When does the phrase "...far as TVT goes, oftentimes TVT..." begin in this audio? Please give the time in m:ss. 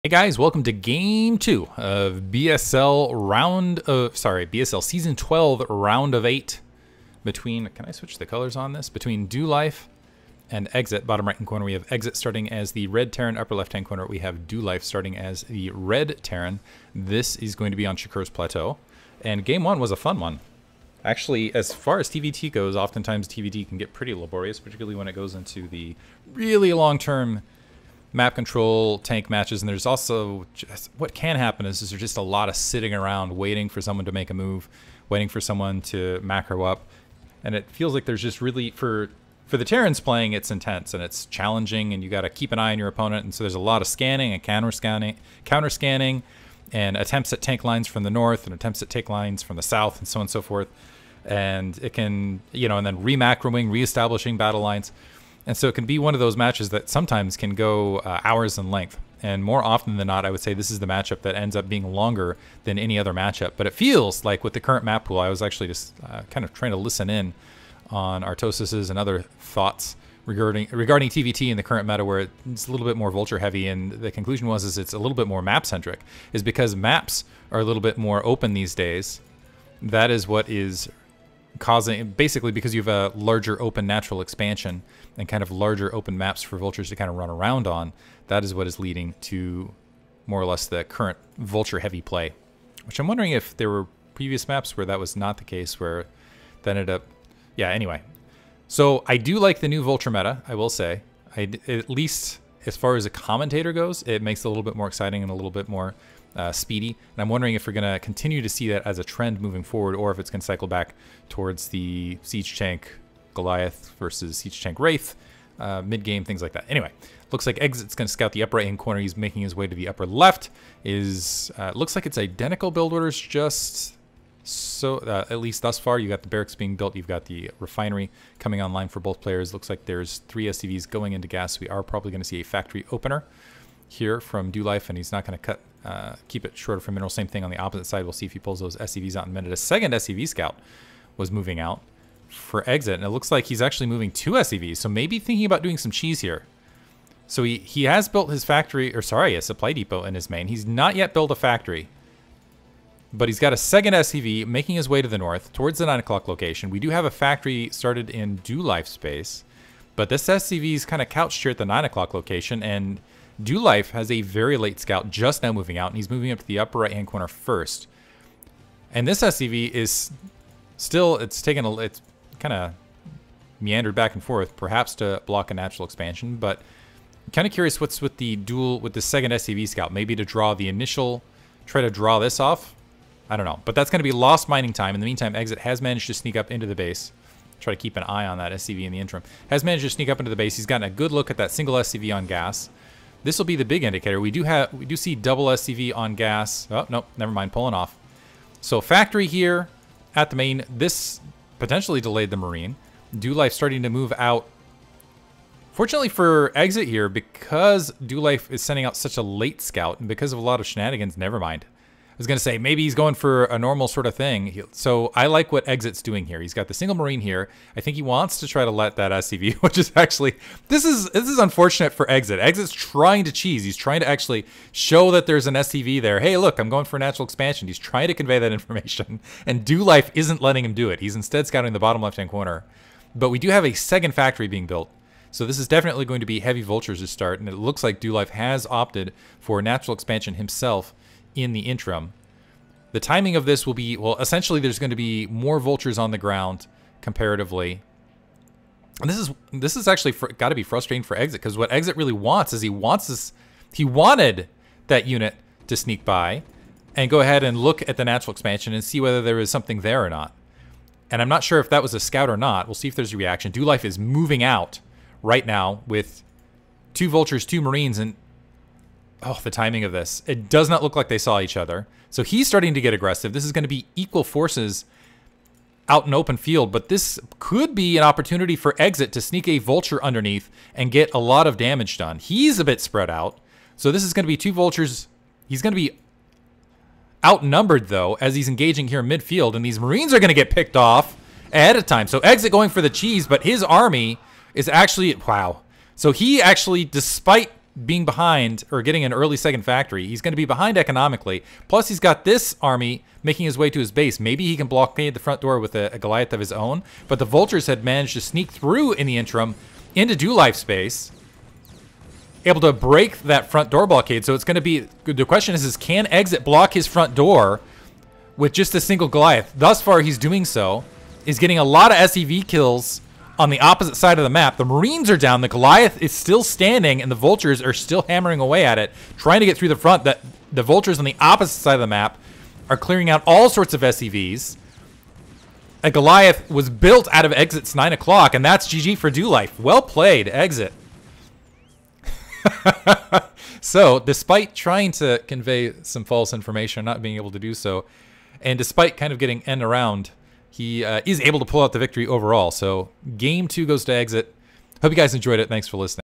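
0:21.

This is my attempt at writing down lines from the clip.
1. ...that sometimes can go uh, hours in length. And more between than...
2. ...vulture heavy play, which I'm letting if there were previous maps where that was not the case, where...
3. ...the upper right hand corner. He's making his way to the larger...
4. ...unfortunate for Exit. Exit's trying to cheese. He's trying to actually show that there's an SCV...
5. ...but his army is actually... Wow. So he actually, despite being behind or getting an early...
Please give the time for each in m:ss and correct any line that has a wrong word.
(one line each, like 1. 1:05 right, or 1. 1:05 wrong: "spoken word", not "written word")
1. 0:56 wrong: "often", not "between"
2. 1:31 wrong: "wondering", not "letting"
3. 1:58 wrong: "upper", not "larger"
4. 3:41 right
5. 4:53 right.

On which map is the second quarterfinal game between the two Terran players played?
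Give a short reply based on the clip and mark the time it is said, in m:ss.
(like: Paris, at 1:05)
Shakur's Plateau, at 0:17.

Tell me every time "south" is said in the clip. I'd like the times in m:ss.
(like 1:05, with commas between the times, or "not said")
0:49.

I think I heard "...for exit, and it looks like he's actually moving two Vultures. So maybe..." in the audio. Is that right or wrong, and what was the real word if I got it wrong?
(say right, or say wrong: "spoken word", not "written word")
wrong: "SCVs", not "Vultures".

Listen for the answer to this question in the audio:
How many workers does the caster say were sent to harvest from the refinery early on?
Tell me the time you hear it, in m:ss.
2:10.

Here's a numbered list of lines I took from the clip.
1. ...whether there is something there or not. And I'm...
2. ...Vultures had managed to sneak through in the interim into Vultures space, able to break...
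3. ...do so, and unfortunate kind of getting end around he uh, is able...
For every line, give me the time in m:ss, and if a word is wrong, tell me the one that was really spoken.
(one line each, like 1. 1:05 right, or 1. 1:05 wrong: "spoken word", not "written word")
1. 4:18 right
2. 5:07 wrong: "Dolife", not "Vultures"
3. 5:47 wrong: "despite", not "unfortunate".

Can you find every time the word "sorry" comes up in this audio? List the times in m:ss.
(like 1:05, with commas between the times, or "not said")
0:04, 2:29.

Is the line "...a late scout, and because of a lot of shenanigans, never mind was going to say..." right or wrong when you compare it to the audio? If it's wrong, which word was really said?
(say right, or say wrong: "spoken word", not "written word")
right.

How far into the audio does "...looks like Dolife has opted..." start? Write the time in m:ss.
3:57.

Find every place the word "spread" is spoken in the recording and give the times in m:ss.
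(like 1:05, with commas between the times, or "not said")
4:42.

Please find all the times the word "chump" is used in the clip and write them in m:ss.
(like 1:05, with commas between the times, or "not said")
not said.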